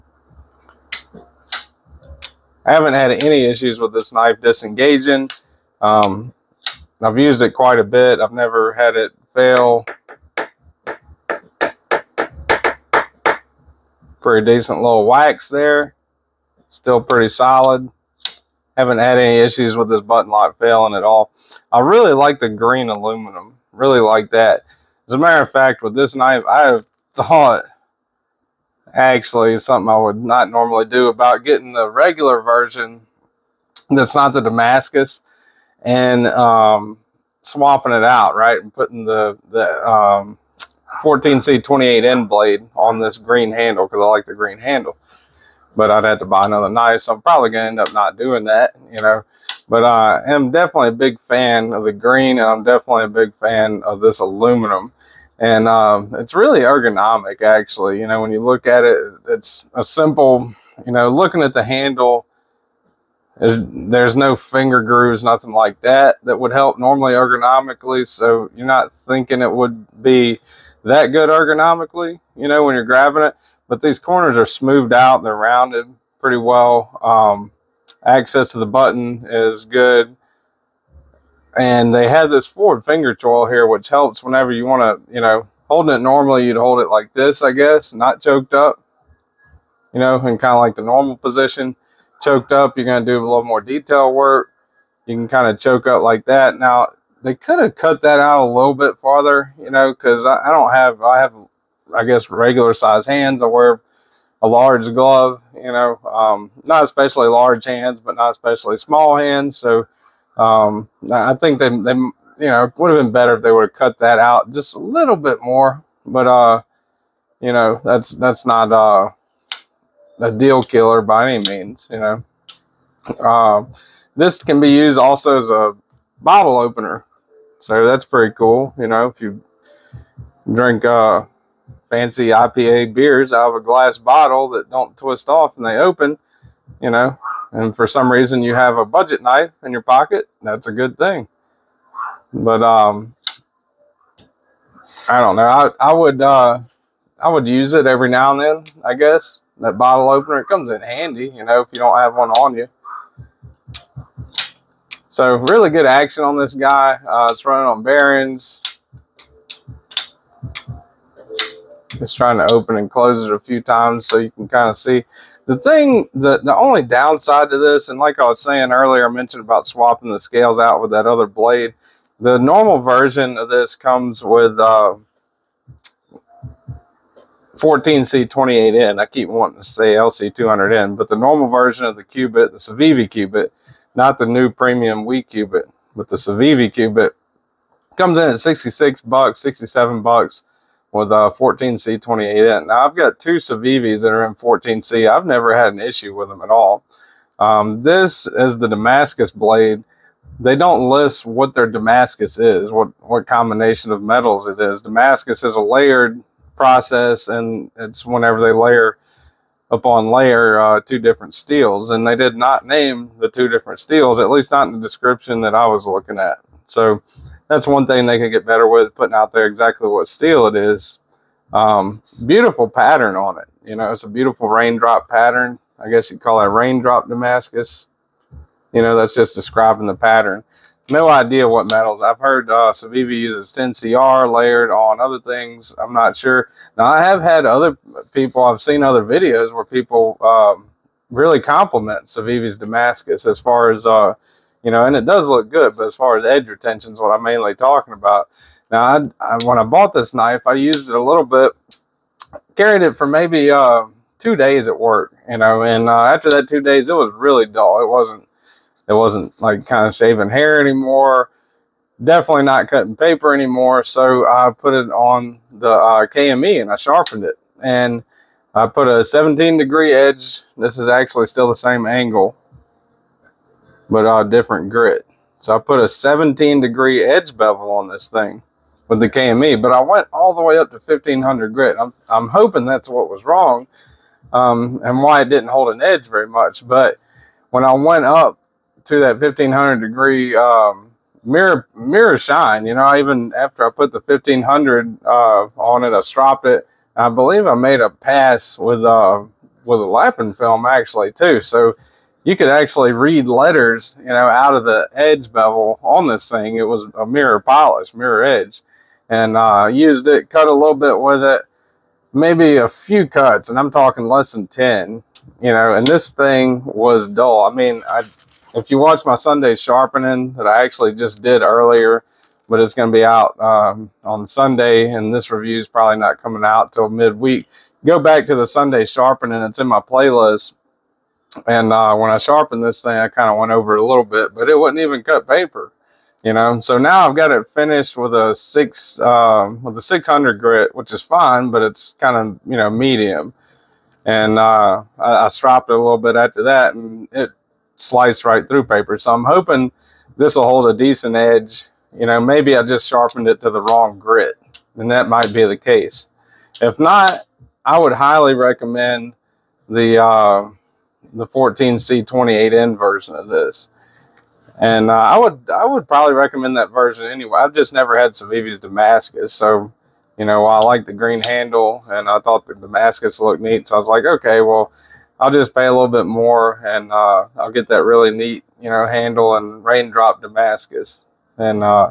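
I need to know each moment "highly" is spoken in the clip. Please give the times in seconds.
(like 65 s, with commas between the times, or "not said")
357 s.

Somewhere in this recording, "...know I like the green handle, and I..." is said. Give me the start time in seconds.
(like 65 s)
370 s.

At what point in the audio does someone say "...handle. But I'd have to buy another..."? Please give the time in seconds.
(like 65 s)
44 s.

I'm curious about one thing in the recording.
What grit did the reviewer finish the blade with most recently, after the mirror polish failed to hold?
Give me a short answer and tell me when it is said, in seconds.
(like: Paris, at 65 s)
600, at 339 s.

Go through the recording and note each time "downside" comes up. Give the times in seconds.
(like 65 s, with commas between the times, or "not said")
166 s.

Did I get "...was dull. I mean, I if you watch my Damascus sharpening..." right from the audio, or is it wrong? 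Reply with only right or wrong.
wrong.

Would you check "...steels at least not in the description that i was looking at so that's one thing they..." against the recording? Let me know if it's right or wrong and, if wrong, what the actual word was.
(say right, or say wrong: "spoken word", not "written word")
right.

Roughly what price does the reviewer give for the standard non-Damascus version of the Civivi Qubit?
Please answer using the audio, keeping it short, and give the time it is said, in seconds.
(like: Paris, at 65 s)
$66, at 188 s.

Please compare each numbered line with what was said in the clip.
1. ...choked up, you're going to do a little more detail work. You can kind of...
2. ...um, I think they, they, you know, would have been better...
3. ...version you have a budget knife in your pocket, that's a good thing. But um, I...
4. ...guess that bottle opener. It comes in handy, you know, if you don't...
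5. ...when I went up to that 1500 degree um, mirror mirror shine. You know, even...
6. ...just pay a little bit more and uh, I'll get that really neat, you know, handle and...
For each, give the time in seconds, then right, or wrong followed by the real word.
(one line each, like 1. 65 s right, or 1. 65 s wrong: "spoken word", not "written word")
1. 92 s right
2. 110 s right
3. 138 s wrong: "reason", not "version"
4. 148 s right
5. 287 s right
6. 375 s right.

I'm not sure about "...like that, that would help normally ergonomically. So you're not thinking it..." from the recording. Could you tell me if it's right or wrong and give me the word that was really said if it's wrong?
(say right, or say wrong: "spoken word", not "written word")
right.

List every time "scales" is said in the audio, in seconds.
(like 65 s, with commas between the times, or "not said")
170 s.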